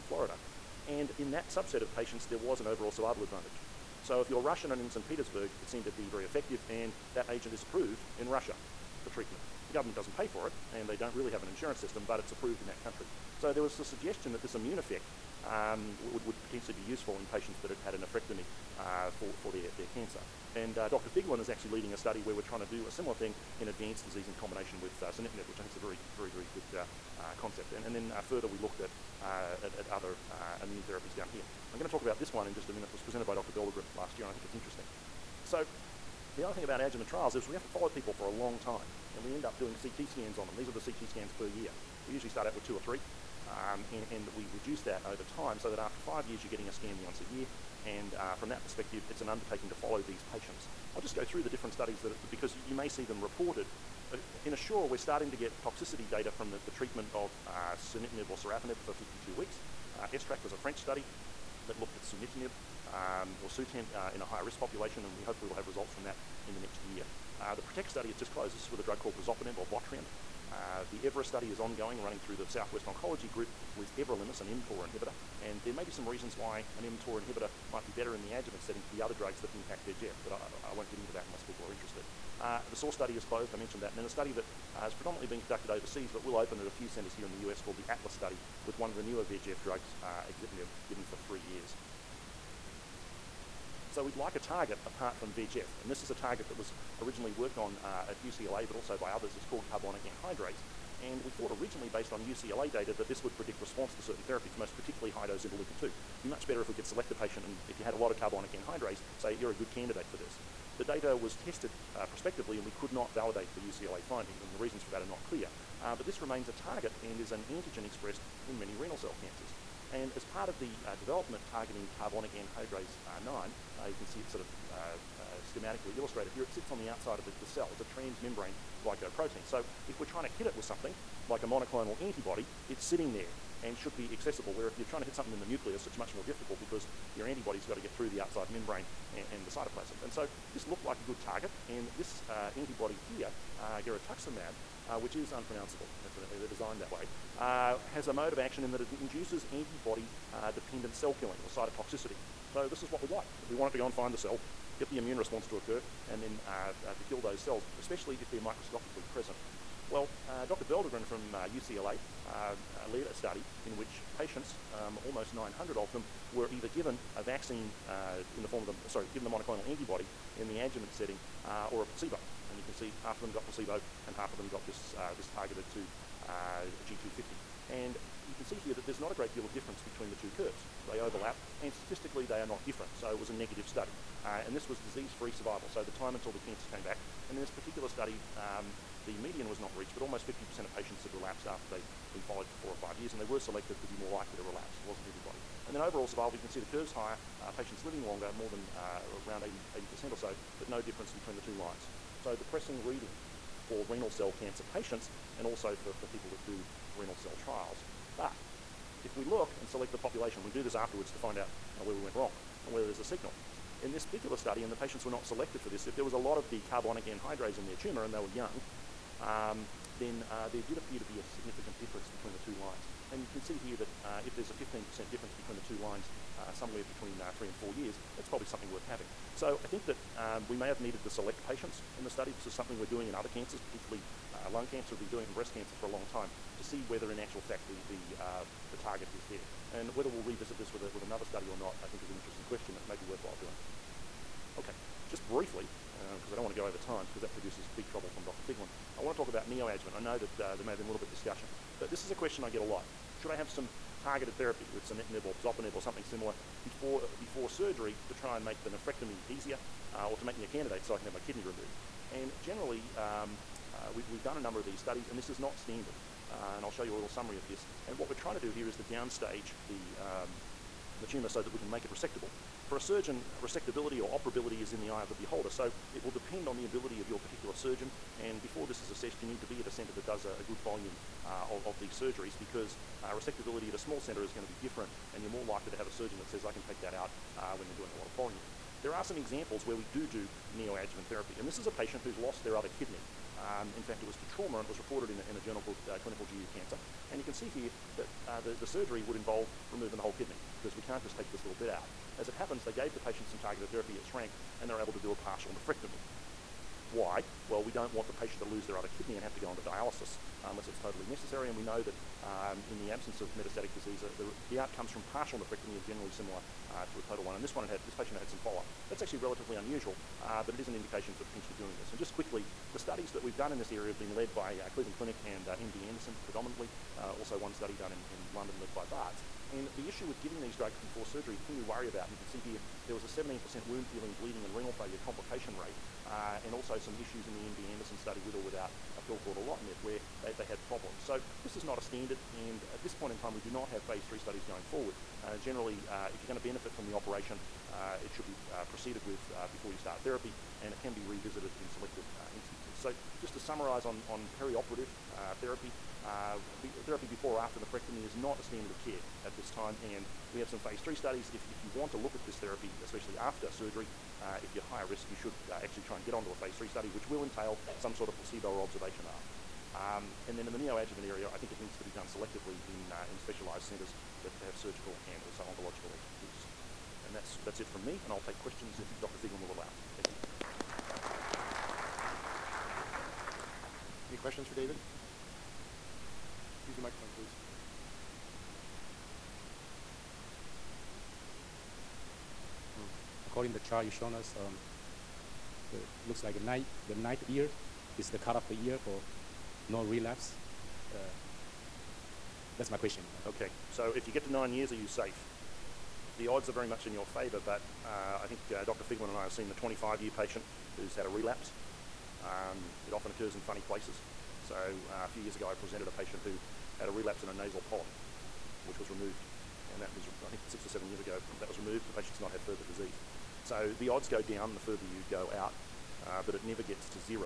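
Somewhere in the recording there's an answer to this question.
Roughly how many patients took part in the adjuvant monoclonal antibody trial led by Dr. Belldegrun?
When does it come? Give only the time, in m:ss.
2:45.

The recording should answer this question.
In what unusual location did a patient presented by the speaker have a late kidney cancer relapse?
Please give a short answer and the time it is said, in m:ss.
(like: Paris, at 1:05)
a nasal polyp, at 6:57.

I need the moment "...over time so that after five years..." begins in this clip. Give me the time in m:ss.
0:45.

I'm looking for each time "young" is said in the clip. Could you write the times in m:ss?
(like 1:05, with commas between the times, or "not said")
3:38.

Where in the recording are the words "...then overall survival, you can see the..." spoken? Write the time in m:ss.
3:15.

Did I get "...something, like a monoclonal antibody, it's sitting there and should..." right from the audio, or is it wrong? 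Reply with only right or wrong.
right.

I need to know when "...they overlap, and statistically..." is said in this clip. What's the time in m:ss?
3:00.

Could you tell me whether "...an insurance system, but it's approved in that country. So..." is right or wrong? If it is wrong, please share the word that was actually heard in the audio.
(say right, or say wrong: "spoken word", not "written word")
right.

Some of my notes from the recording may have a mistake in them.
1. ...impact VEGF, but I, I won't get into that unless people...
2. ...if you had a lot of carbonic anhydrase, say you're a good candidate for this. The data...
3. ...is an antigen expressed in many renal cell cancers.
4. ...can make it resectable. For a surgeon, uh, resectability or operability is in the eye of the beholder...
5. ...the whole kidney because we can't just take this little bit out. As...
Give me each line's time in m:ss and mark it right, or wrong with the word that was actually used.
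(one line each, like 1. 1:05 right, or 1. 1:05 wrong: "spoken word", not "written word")
1. 1:19 right
2. 1:47 right
3. 1:57 right
4. 4:31 right
5. 4:59 right.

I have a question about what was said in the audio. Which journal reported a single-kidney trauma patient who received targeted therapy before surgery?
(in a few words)
Clinical GU Cancer.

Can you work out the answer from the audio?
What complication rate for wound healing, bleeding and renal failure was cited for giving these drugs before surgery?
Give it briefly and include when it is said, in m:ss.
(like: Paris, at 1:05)
17%, at 5:33.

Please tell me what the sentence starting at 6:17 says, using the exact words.
And that's, that's it from me, and I'll take questions if Dr.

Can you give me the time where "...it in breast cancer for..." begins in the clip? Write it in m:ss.
3:55.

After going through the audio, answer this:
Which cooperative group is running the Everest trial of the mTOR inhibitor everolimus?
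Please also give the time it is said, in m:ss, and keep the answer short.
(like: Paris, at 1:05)
Southwest Oncology Group, at 1:12.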